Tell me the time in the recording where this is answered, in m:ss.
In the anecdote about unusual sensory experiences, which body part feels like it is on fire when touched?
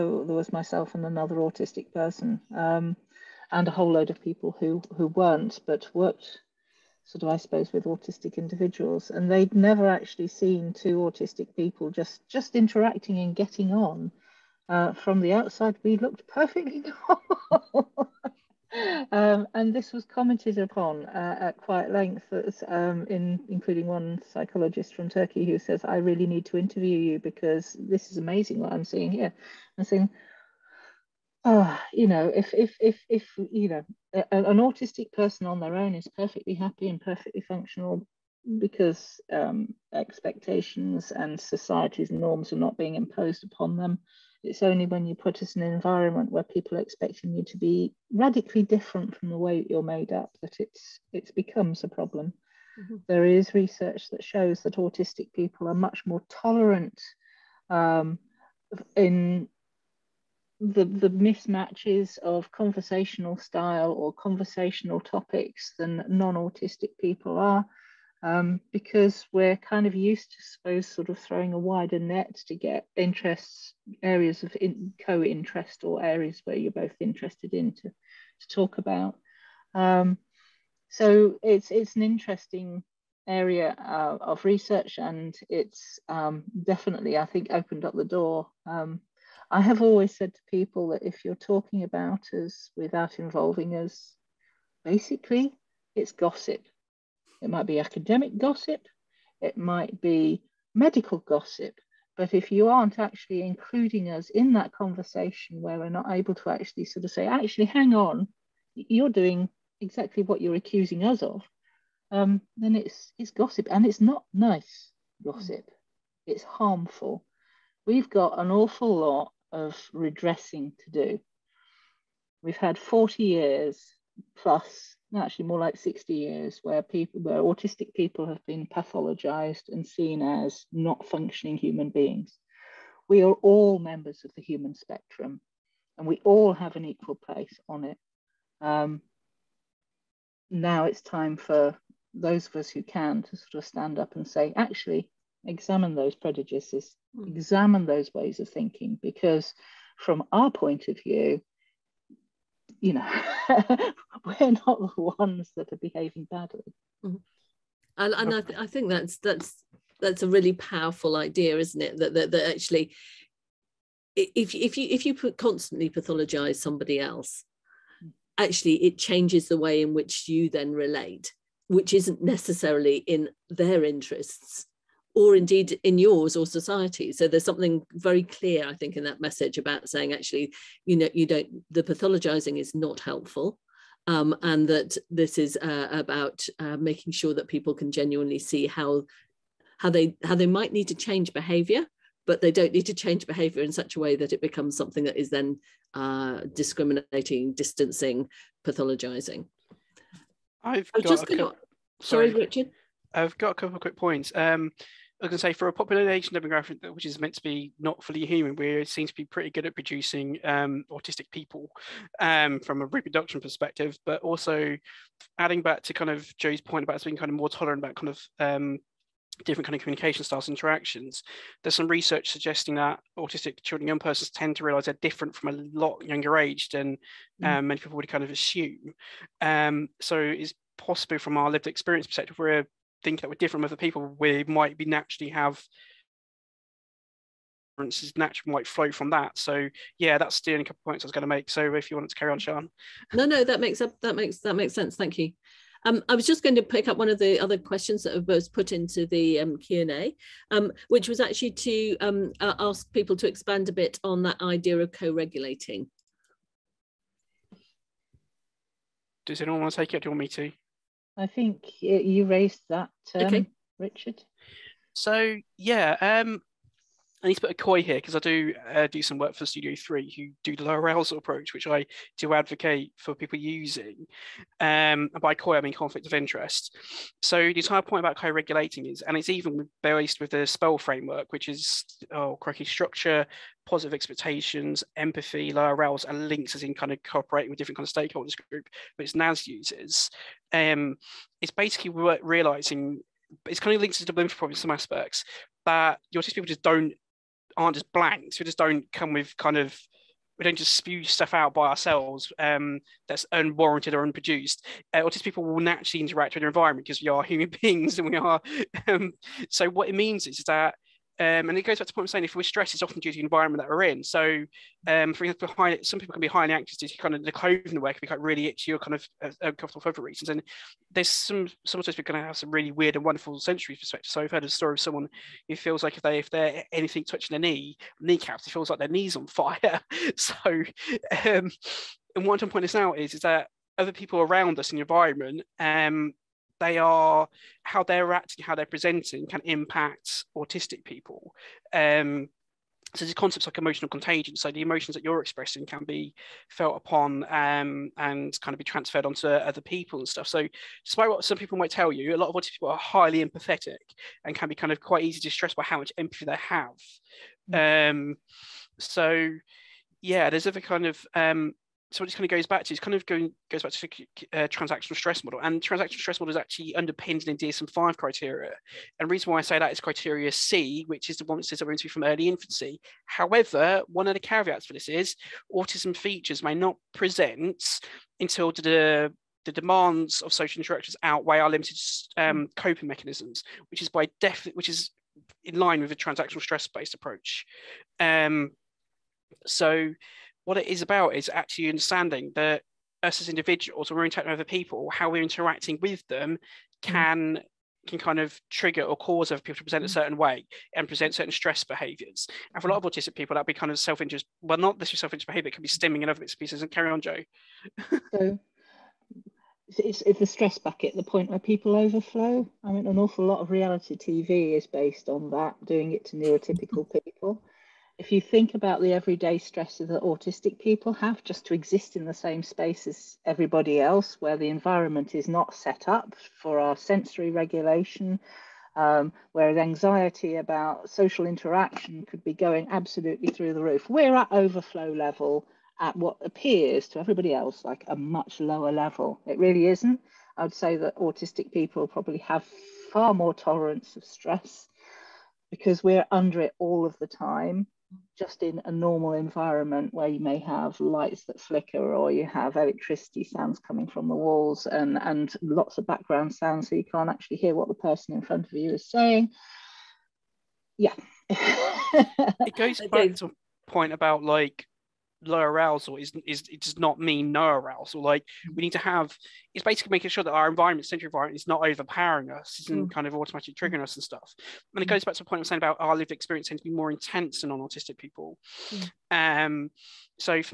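5:28.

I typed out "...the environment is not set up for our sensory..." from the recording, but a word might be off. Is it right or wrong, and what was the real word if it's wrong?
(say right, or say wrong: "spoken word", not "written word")
right.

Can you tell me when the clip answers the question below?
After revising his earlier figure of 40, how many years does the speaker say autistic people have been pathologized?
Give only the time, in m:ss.
2:05.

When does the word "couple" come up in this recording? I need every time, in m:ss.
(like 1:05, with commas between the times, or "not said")
3:23, 4:00.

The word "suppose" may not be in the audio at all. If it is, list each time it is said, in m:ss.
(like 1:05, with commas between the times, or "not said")
0:07, 1:10.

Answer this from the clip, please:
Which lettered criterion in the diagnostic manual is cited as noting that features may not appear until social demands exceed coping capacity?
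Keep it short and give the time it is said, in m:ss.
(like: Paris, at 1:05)
Criteria C, at 6:09.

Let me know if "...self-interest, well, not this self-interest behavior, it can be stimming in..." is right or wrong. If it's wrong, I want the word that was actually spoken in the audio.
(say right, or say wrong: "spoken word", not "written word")
right.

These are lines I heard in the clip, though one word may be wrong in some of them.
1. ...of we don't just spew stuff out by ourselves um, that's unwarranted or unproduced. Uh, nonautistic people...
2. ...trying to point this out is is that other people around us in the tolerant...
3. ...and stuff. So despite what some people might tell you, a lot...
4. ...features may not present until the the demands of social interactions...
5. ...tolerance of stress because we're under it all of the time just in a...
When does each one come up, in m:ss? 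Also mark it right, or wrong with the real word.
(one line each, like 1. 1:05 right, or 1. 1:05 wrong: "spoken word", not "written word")
1. 4:59 wrong: "autistic", not "nonautistic"
2. 5:32 wrong: "environment", not "tolerant"
3. 5:49 right
4. 6:15 right
5. 7:23 right.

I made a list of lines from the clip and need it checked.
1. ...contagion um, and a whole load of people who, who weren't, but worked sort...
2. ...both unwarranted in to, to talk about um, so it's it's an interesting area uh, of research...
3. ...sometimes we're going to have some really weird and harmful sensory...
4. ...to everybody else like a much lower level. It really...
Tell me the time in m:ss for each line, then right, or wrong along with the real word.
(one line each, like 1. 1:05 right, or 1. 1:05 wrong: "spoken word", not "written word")
1. 0:01 wrong: "person", not "contagion"
2. 1:16 wrong: "interested", not "unwarranted"
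3. 5:21 wrong: "wonderful", not "harmful"
4. 7:16 right.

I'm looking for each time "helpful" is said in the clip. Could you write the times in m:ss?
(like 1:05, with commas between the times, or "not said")
3:03.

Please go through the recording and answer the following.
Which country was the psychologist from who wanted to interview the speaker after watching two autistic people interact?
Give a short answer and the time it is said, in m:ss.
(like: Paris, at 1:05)
Turkey, at 0:25.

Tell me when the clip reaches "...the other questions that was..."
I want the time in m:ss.
4:07.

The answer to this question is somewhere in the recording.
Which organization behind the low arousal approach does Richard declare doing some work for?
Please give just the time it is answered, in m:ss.
4:29.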